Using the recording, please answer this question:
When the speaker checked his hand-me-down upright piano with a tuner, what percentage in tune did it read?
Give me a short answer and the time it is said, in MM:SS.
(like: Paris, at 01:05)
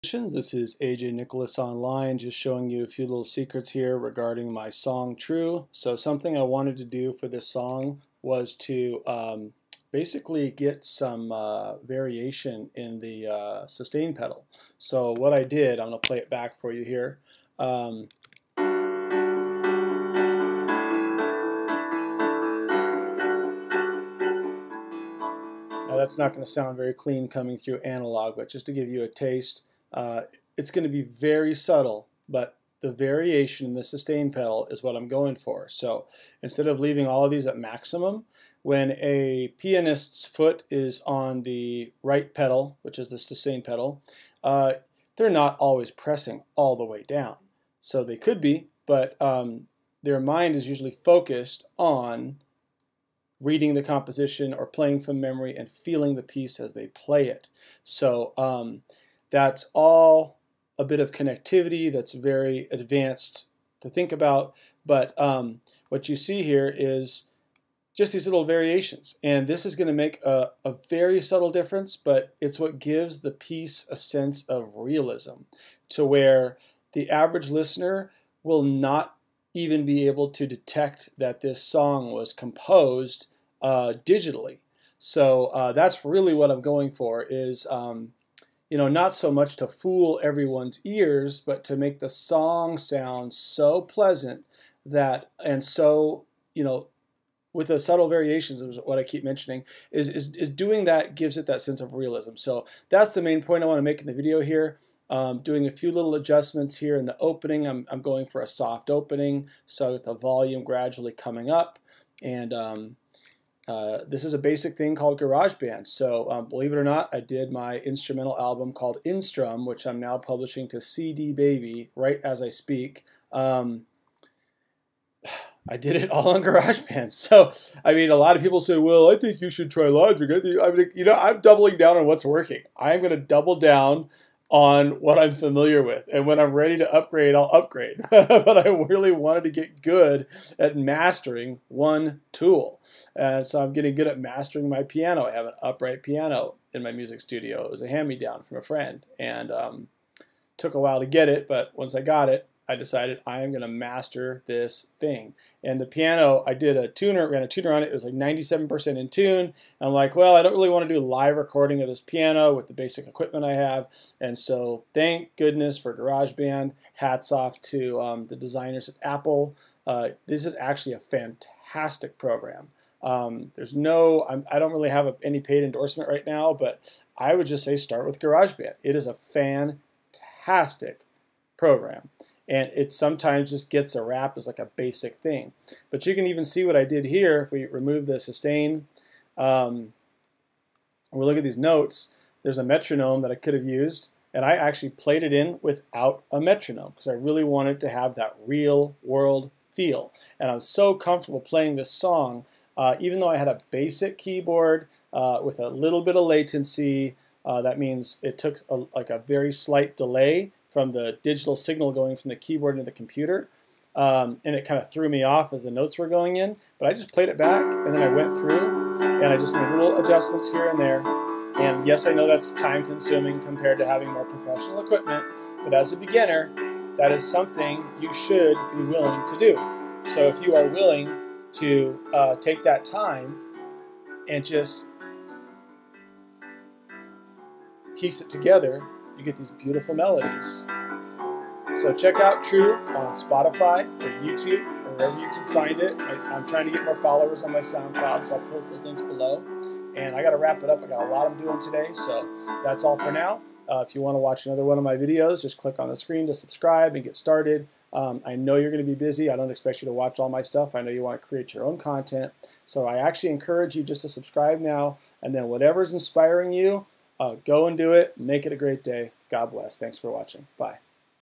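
97%, at 02:38.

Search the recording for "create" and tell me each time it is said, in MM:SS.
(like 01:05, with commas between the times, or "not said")
04:21.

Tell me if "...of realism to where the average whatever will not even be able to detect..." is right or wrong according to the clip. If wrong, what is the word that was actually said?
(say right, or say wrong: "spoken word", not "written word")
wrong: "listener", not "whatever".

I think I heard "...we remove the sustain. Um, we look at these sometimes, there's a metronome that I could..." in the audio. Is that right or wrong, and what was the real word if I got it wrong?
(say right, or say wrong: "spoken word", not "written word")
wrong: "notes", not "sometimes".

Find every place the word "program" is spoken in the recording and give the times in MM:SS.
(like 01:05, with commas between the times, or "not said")
02:52, 03:01.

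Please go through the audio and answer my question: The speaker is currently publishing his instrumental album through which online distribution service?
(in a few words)
CD Baby.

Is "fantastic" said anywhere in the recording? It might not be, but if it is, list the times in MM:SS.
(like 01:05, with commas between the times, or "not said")
02:50, 02:59.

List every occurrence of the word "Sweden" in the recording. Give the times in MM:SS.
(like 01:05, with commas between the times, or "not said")
not said.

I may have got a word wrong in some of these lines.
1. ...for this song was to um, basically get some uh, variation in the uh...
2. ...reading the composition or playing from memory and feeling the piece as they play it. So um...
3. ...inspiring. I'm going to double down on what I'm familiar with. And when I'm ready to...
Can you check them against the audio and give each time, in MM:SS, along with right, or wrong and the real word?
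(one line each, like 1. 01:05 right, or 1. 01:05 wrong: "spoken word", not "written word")
1. 00:07 right
2. 00:53 right
3. 02:12 wrong: "working", not "inspiring".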